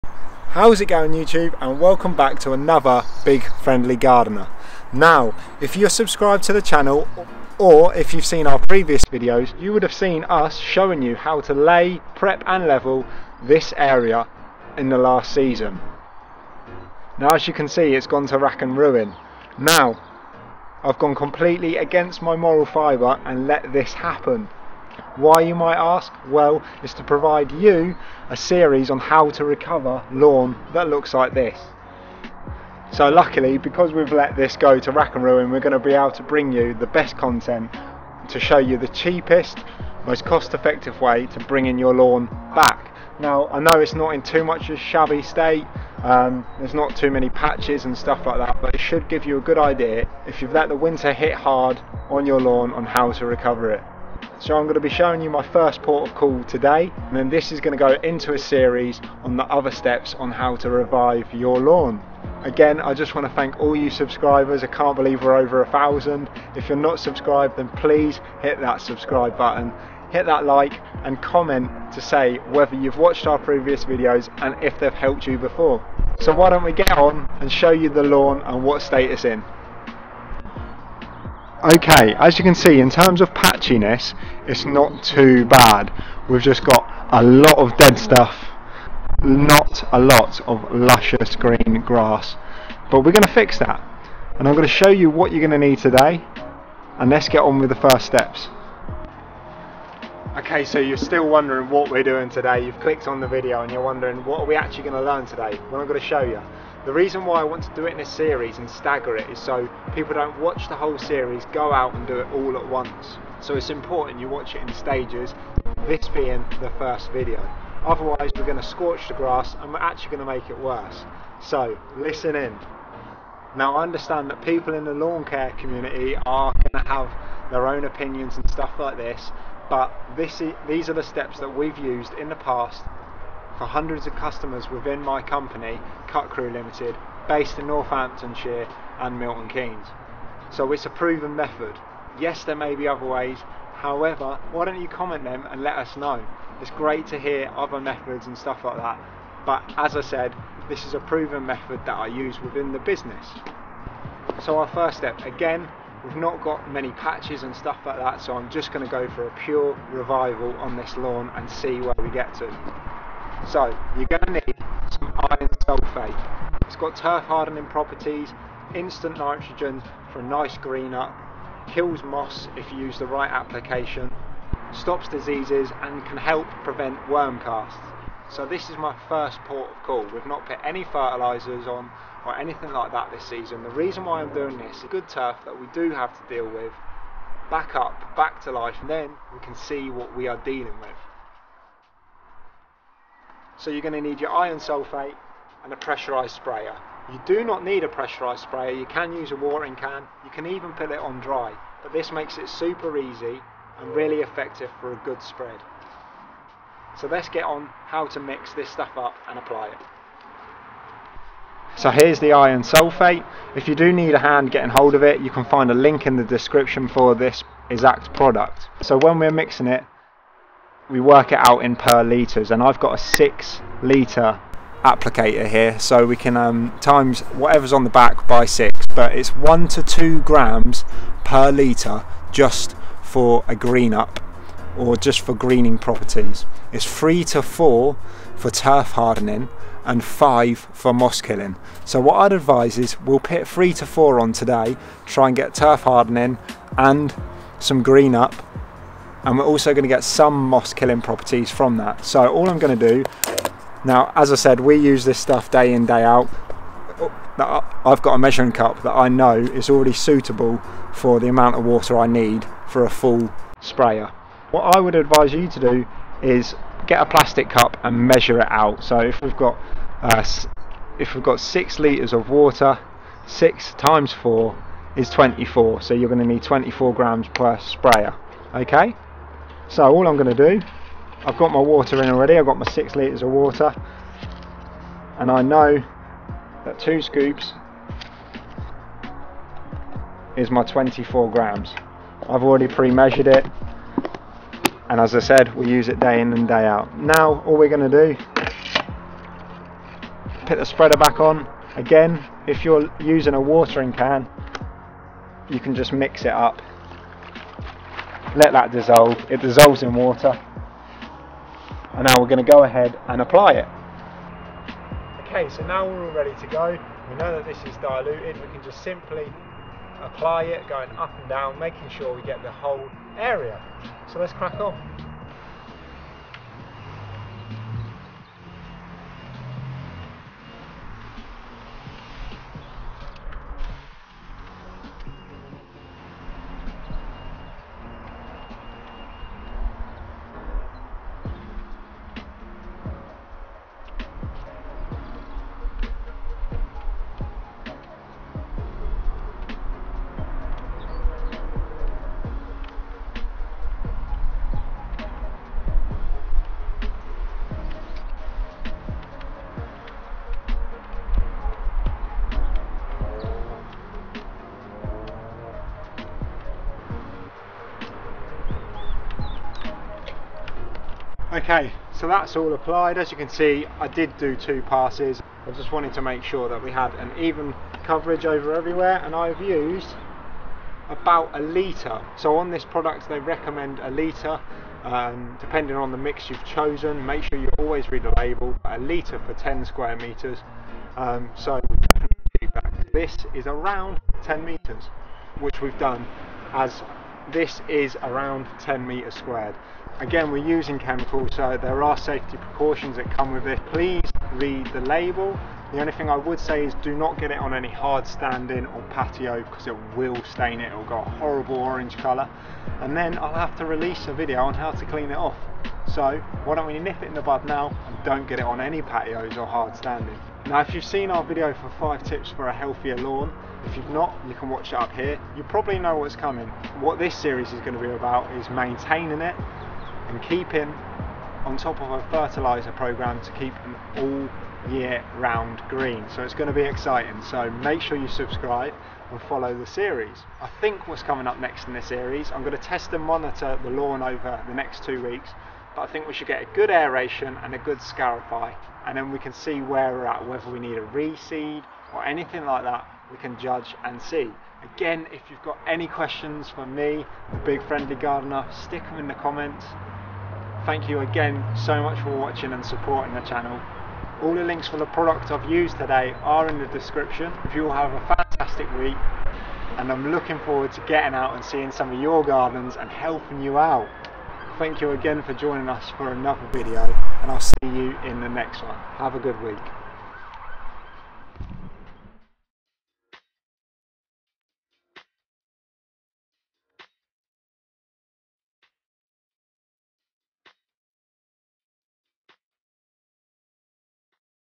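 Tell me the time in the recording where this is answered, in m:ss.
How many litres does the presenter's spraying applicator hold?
3:42.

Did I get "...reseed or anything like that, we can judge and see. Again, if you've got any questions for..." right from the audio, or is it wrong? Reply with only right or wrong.
right.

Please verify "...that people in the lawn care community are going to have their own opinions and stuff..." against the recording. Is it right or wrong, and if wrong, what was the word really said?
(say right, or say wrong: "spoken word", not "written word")
right.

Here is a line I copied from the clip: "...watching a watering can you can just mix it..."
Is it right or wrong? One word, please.
wrong.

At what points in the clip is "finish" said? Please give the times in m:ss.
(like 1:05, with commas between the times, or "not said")
not said.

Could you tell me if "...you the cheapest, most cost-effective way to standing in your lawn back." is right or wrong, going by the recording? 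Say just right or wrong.
wrong.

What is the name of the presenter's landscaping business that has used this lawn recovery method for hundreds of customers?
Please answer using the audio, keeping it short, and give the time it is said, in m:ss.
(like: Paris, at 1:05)
Cut Crew Limited, at 2:16.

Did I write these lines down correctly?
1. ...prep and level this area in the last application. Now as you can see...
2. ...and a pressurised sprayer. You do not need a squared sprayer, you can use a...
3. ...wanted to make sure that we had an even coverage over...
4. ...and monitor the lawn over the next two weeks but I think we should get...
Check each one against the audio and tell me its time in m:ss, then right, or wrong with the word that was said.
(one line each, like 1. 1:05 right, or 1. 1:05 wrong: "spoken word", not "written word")
1. 0:12 wrong: "season", not "application"
2. 3:15 wrong: "pressurised", not "squared"
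3. 6:15 right
4. 7:22 right.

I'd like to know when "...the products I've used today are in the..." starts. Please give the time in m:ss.
7:44.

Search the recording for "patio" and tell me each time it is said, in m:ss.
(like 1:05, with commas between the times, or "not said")
6:48, 6:58.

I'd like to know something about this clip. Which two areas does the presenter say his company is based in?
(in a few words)
Northamptonshire and Milton Keynes.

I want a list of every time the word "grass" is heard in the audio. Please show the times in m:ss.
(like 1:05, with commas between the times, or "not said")
1:31, 1:59.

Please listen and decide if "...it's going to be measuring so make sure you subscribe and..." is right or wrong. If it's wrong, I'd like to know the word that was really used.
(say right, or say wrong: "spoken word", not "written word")
wrong: "exciting", not "measuring".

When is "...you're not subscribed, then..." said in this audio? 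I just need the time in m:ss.
1:06.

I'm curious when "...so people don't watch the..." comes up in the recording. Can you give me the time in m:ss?
1:49.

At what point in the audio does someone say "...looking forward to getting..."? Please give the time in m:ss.
7:50.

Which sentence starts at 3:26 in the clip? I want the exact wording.
So let's get on how to mix this stuff up and apply it.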